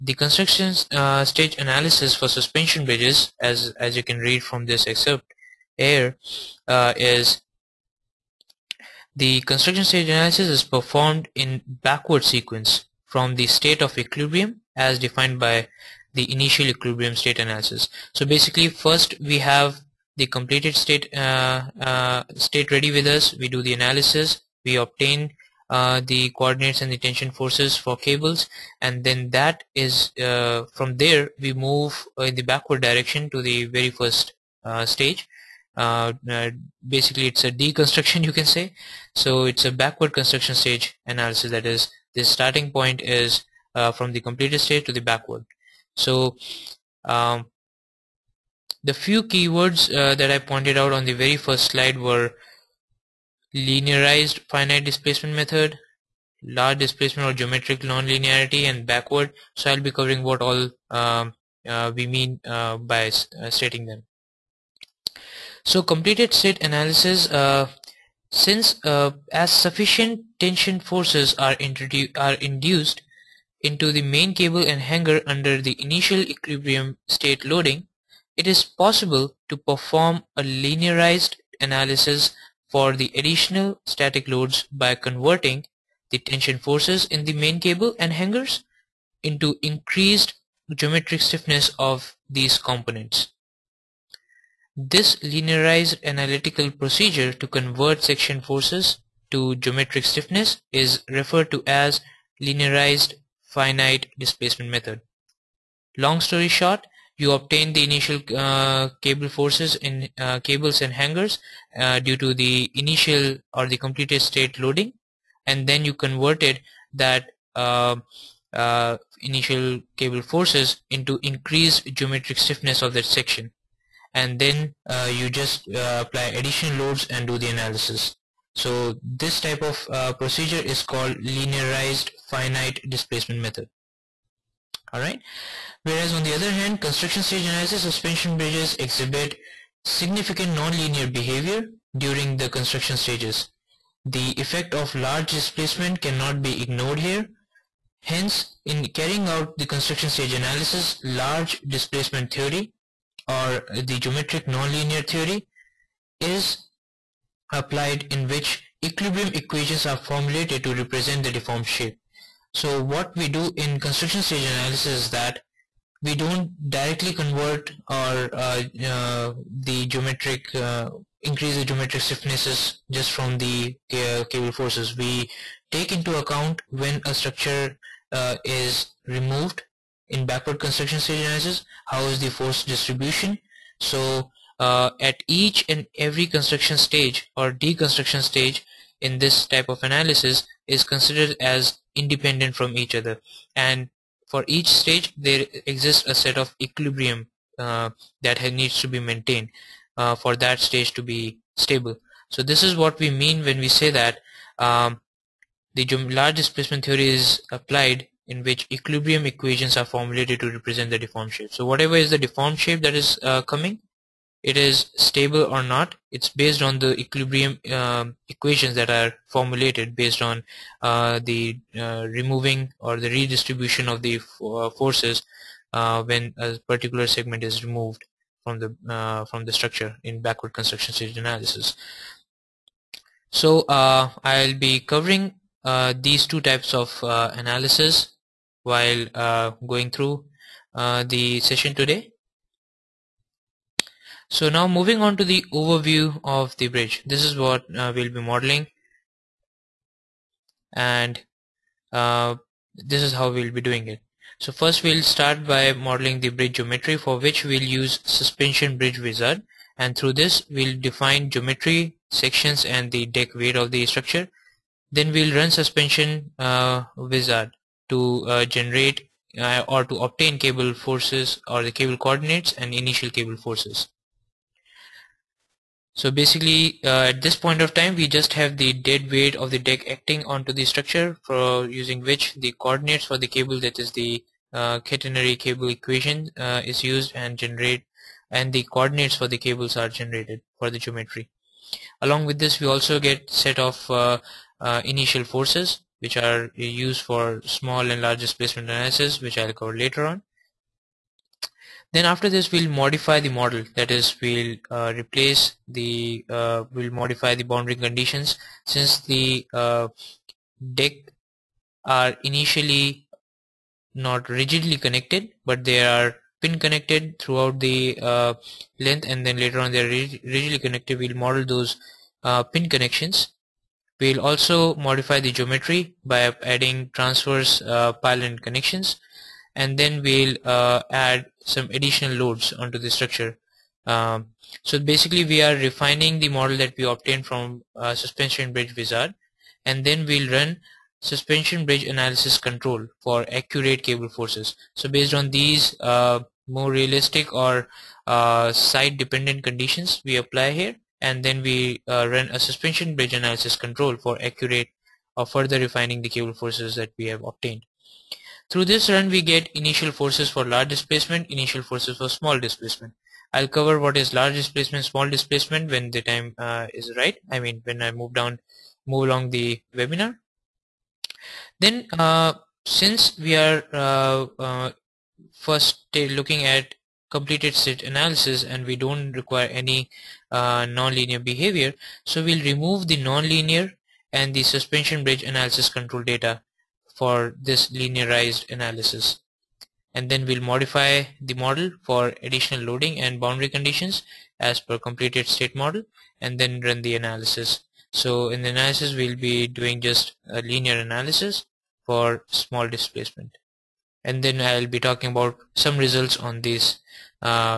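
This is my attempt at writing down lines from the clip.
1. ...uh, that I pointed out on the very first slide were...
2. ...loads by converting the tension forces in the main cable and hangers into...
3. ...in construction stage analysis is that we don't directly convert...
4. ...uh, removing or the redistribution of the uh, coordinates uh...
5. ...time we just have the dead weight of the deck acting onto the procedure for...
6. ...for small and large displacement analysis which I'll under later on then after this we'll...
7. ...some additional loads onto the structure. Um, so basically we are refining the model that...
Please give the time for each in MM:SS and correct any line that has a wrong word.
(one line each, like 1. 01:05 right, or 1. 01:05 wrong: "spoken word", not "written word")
1. 00:49 right
2. 01:24 right
3. 02:43 right
4. 03:41 wrong: "forces", not "coordinates"
5. 04:37 wrong: "structure", not "procedure"
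6. 04:57 wrong: "cover", not "under"
7. 05:31 right.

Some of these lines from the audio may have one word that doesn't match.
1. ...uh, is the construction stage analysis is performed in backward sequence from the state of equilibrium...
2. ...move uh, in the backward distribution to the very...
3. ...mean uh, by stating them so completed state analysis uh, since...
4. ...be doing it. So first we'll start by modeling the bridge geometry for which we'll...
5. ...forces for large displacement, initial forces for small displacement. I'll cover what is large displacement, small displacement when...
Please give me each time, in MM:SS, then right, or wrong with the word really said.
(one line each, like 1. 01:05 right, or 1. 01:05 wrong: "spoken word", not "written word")
1. 00:06 right
2. 00:31 wrong: "direction", not "distribution"
3. 01:02 right
4. 04:13 right
5. 05:59 right.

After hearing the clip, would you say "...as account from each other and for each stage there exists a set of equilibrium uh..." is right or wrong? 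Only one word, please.
wrong.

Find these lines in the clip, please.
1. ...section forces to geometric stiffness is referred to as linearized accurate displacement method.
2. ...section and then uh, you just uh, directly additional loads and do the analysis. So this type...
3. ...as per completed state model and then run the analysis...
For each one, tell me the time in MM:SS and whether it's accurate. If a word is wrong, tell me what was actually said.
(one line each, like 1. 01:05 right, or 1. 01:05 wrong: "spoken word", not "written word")
1. 01:38 wrong: "finite", not "accurate"
2. 02:03 wrong: "apply", not "directly"
3. 06:34 right.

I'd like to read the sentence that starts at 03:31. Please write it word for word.
So whatever is the deformed shape that is uh, coming, it is stable or not.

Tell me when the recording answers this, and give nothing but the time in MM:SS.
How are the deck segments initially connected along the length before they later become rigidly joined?
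05:16.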